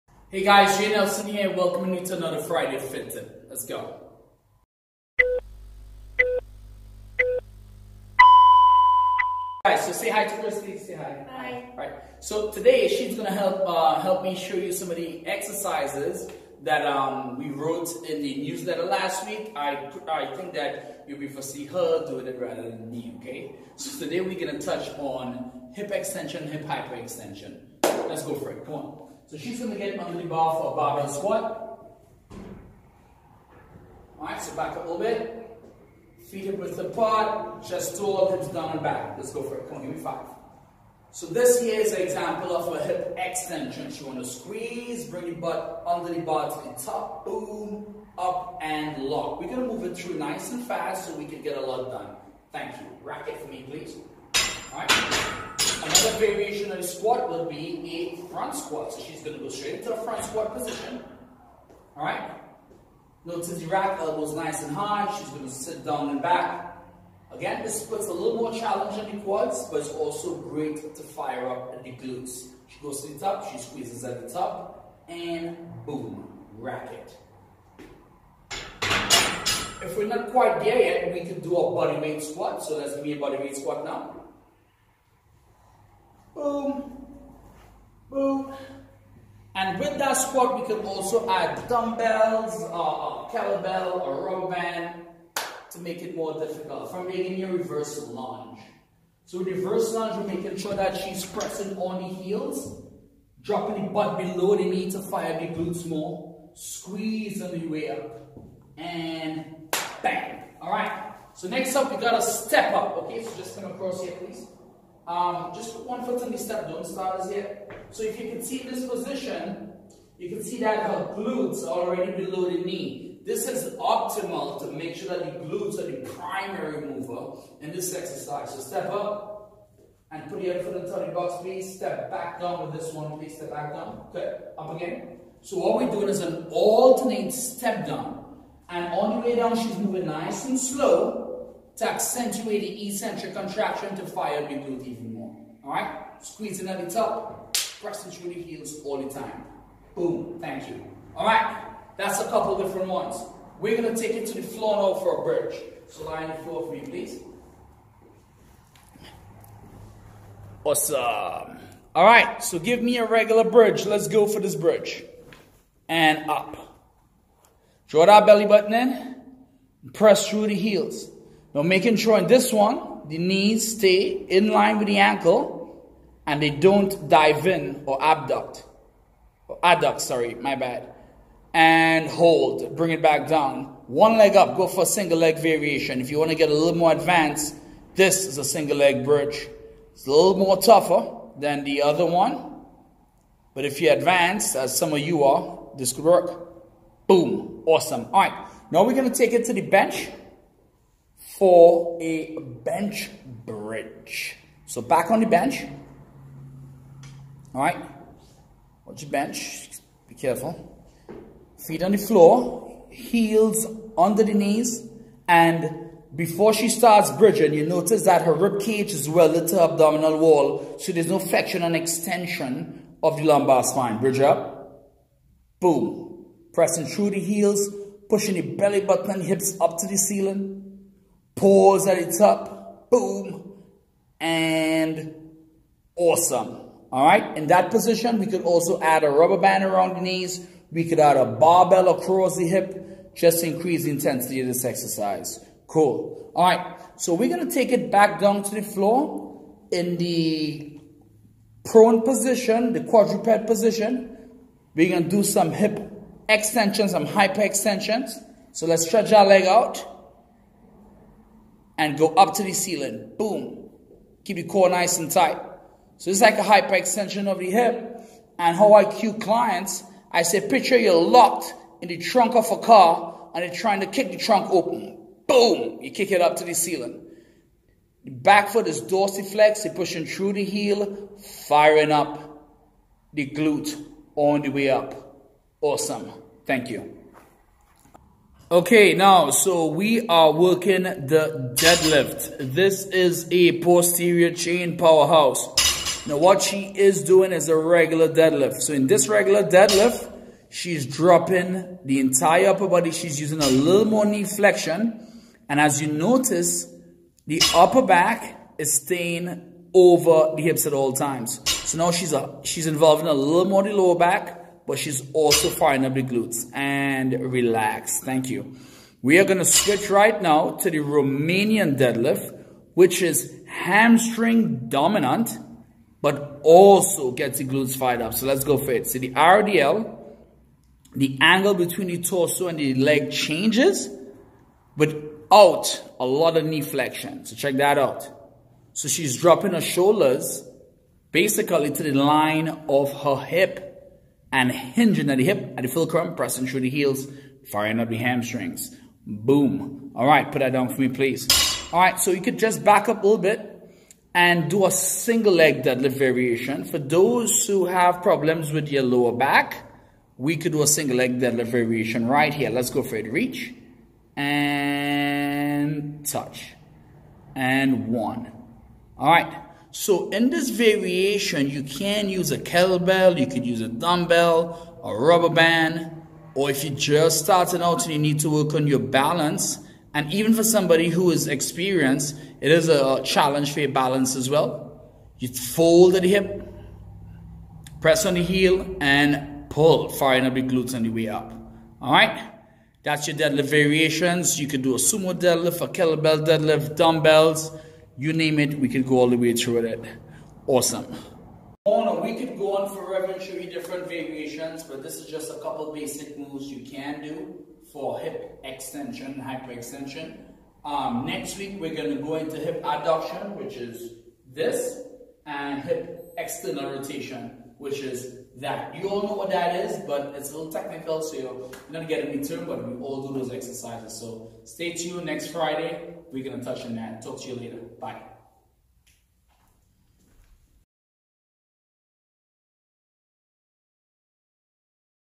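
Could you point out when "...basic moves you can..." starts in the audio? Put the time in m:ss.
6:45.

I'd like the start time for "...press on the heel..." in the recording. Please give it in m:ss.
6:27.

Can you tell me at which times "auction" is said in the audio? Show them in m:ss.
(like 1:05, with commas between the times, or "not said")
not said.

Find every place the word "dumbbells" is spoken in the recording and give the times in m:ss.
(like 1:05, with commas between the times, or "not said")
1:31, 6:13, 6:36.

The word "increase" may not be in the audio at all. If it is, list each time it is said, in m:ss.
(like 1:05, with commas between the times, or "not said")
4:03.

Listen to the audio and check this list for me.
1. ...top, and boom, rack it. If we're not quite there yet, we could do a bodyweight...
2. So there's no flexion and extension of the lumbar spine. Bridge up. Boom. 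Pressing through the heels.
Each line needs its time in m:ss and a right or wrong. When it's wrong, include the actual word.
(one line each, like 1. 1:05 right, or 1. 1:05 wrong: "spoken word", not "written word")
1. 1:14 right
2. 3:40 right.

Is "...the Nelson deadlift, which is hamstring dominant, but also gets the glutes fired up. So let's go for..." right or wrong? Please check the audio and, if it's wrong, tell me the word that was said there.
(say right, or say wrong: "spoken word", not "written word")
wrong: "Romanian", not "Nelson".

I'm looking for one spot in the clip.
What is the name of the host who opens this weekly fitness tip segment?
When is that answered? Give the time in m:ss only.
0:00.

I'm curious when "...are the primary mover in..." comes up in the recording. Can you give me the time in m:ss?
2:05.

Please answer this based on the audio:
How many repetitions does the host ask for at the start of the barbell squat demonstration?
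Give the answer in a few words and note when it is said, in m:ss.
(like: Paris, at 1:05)
5, at 0:40.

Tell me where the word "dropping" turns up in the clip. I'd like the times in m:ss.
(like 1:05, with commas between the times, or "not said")
1:43, 5:00, 5:39.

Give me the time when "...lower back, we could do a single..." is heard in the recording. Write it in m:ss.
5:58.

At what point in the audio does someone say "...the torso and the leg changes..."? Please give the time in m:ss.
5:31.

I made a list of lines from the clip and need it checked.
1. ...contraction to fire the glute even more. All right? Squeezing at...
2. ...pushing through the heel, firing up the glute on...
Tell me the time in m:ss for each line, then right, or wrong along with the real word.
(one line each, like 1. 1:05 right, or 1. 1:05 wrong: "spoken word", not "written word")
1. 2:23 right
2. 4:39 right.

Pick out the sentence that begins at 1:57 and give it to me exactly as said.
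So if you can see this position, you can see that her glutes are already below the knee.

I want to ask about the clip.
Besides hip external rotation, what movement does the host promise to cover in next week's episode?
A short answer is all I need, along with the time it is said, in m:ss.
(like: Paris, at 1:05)
Hip adduction, at 6:52.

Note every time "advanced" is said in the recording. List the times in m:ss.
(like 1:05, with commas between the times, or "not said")
3:06, 3:13.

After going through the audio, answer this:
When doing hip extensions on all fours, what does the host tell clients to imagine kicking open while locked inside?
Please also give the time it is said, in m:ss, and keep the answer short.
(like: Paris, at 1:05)
The trunk of a car, at 4:31.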